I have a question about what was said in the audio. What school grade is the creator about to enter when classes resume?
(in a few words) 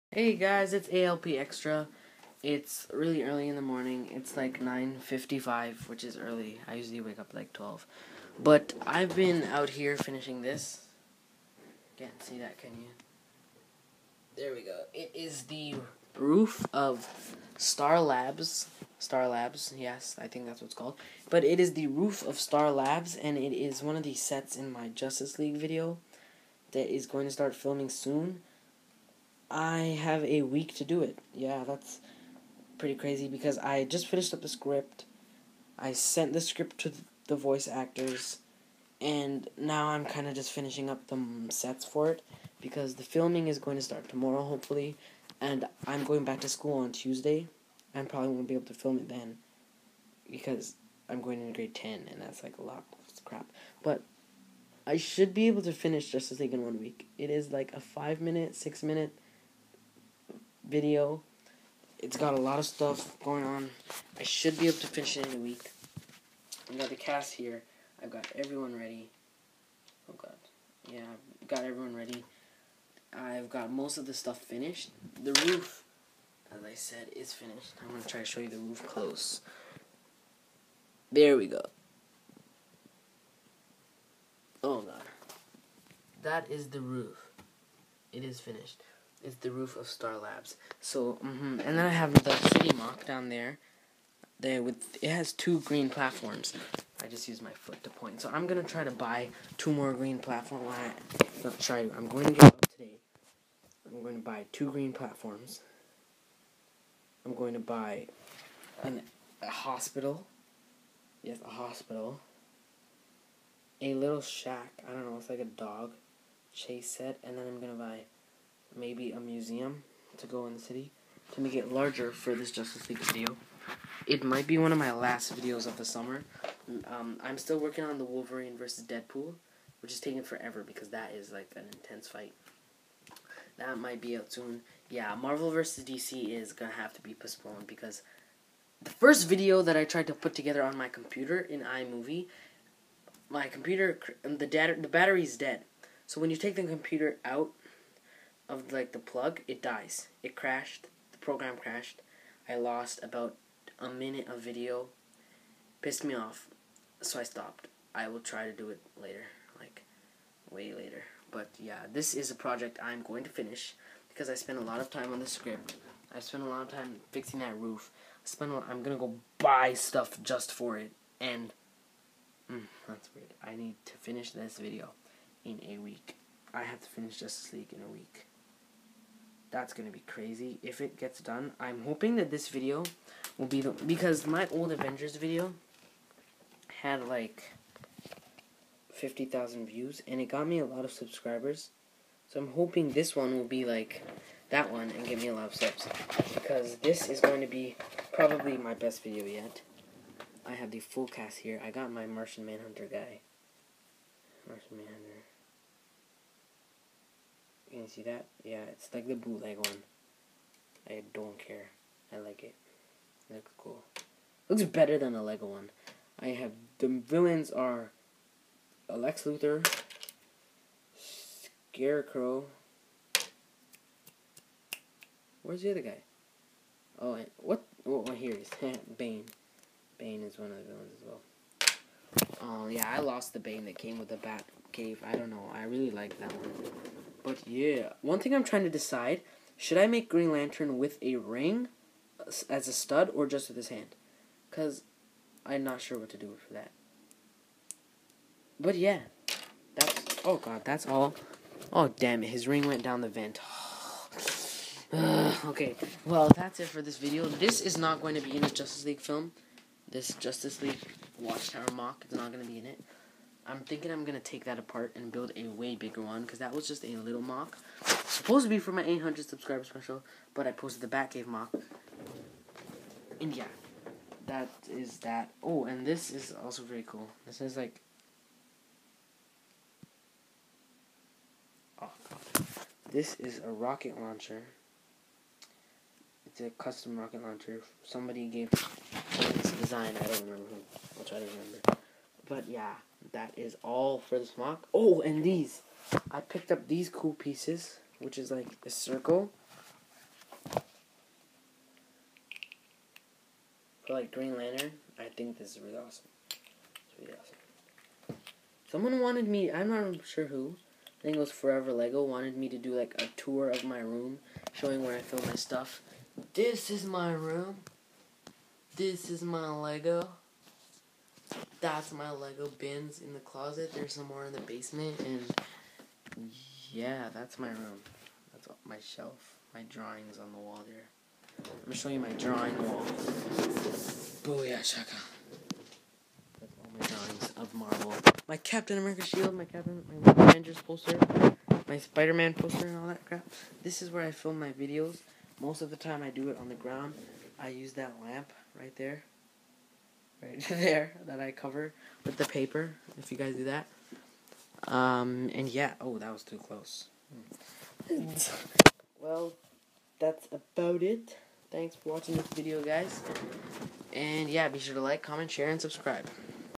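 Grade 10.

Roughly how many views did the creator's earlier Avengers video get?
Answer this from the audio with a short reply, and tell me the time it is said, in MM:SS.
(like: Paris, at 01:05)
50,000, at 03:08.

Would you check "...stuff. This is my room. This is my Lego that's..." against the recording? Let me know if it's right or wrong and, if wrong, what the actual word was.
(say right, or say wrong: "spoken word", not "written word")
right.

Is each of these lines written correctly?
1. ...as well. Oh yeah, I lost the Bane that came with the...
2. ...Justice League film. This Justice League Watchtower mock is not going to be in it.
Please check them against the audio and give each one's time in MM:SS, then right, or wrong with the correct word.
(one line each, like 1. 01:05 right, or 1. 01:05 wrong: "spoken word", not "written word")
1. 03:50 right
2. 04:18 right.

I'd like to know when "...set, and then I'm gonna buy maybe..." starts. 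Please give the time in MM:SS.
01:56.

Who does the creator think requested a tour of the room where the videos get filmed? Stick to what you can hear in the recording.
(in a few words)
Forever Lego.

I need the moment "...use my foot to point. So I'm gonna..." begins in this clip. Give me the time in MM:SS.
01:37.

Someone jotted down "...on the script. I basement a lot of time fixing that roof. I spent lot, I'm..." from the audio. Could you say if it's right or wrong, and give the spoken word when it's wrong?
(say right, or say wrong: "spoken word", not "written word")
wrong: "spent", not "basement".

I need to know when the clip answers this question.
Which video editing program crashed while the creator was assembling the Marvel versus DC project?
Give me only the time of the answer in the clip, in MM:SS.
02:21.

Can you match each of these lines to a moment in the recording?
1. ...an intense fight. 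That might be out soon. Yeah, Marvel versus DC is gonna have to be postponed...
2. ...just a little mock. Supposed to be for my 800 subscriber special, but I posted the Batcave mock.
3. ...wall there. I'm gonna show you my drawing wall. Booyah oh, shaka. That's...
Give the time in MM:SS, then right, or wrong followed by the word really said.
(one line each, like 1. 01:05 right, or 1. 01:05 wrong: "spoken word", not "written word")
1. 02:11 right
2. 04:26 right
3. 05:30 right.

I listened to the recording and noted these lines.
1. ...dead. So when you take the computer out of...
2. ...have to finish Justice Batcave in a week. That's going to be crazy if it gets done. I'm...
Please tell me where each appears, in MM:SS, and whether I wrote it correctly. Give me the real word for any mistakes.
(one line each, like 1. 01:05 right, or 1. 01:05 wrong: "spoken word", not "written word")
1. 02:25 right
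2. 02:56 wrong: "League", not "Batcave".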